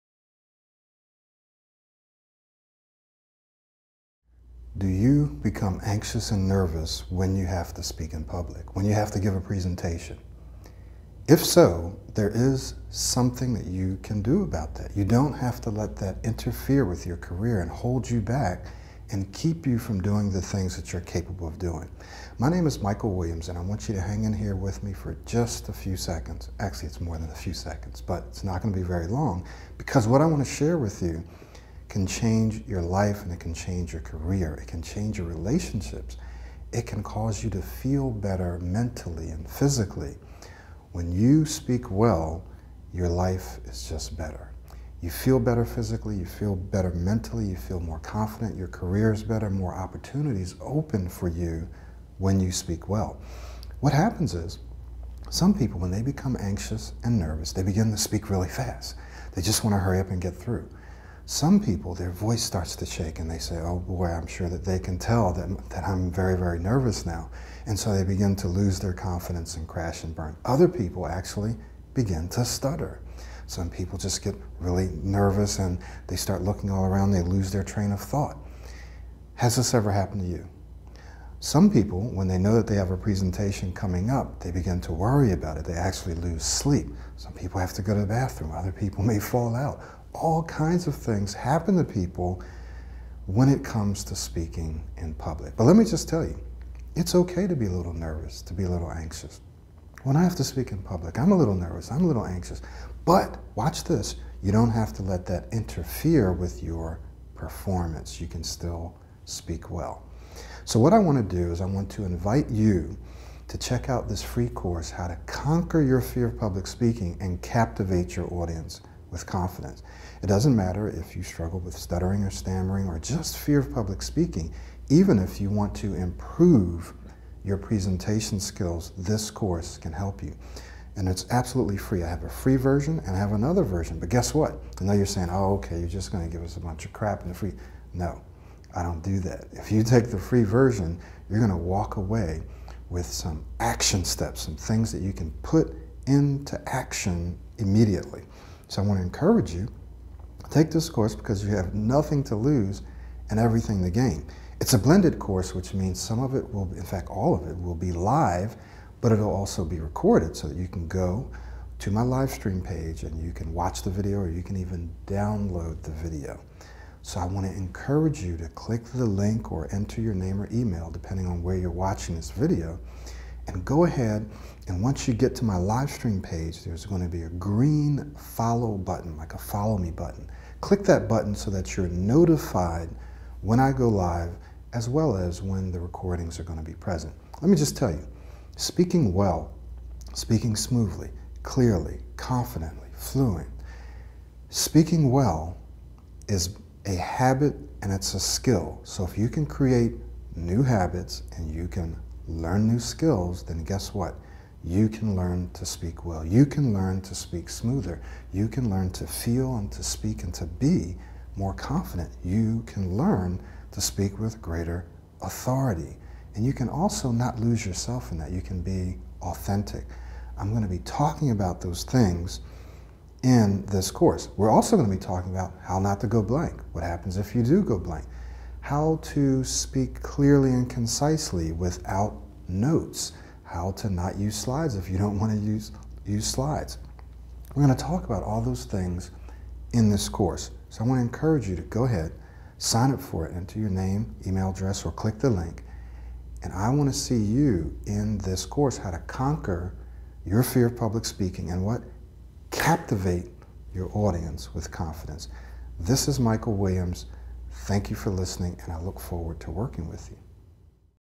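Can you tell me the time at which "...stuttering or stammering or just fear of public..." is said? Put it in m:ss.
2:01.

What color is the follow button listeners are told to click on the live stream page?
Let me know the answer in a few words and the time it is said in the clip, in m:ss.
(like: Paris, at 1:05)
green, at 2:57.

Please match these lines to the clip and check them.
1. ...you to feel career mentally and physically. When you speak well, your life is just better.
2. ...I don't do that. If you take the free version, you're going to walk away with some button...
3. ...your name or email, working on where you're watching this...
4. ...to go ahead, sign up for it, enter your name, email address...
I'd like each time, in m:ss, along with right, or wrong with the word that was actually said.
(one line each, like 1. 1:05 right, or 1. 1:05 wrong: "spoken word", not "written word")
1. 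0:37 wrong: "better", not "career"
2. 2:18 wrong: "action", not "button"
3. 2:49 wrong: "depending", not "working"
4. 4:01 right.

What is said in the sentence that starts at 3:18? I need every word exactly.
So if you can create new habits and you can learn new skills, then guess what?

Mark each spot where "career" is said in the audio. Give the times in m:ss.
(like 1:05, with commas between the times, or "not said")
0:17, 0:34, 0:48.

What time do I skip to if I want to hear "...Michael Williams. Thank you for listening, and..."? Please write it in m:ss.
4:16.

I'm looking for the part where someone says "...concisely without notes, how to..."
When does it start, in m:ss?
3:50.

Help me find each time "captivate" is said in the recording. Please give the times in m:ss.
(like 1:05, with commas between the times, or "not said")
1:57, 4:12.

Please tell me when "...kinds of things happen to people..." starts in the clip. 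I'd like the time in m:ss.
1:30.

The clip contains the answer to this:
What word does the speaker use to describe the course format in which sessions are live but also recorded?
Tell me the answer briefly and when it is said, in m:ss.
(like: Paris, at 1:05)
blended, at 2:34.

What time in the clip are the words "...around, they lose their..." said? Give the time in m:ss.
1:16.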